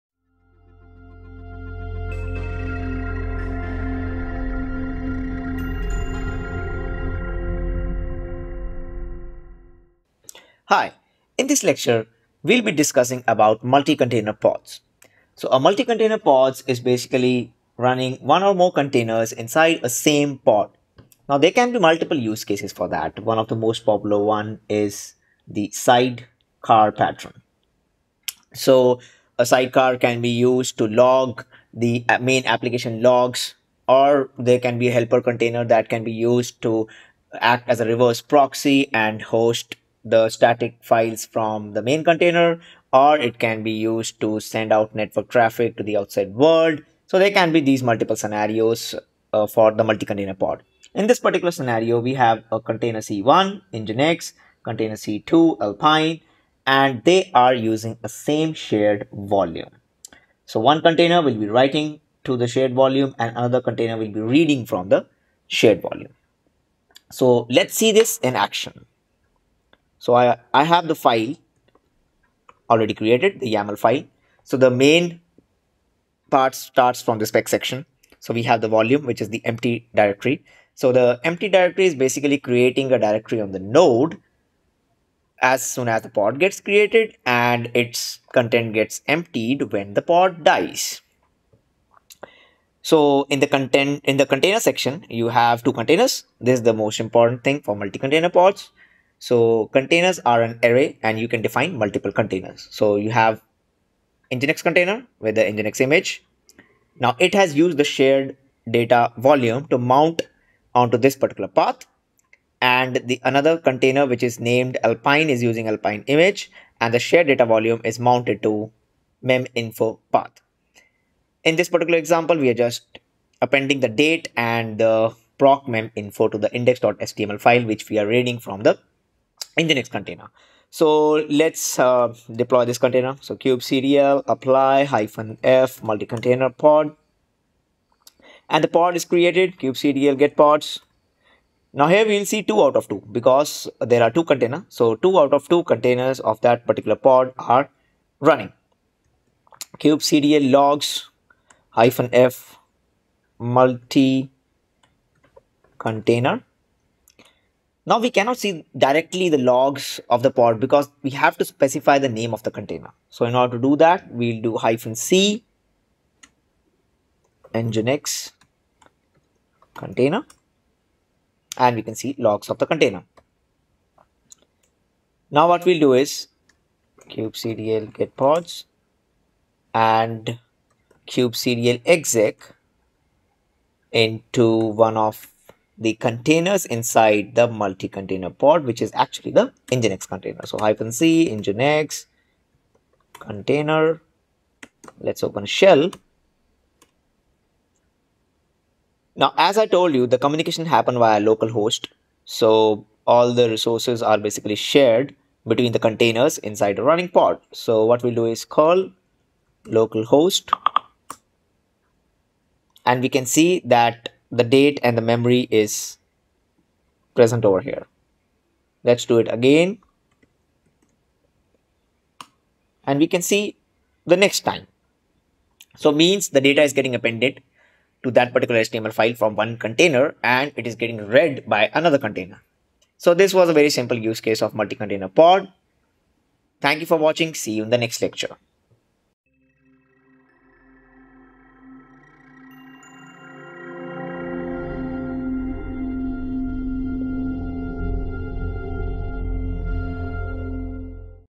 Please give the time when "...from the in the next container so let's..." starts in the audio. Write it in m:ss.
2:08.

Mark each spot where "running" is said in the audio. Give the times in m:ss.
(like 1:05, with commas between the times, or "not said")
0:17, 2:28, 3:26.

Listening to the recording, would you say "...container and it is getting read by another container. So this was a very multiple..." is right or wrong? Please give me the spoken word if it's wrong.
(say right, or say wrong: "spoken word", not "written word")
wrong: "simple", not "multiple".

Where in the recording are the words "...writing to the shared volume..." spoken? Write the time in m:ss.
1:01.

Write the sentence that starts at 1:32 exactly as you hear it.
So in the content in the container section, you have two containers.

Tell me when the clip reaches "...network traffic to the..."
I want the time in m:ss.
0:44.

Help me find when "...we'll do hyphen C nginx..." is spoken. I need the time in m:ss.
2:44.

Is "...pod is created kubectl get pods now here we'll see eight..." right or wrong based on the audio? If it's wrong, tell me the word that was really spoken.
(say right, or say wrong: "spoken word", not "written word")
wrong: "two", not "eight".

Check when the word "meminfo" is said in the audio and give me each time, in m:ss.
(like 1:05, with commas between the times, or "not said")
1:59, 2:05.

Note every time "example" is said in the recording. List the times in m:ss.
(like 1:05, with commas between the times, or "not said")
2:01.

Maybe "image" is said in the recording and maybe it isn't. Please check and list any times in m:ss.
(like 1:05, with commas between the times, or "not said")
1:45, 1:56.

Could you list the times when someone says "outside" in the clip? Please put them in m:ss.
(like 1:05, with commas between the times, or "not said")
0:45.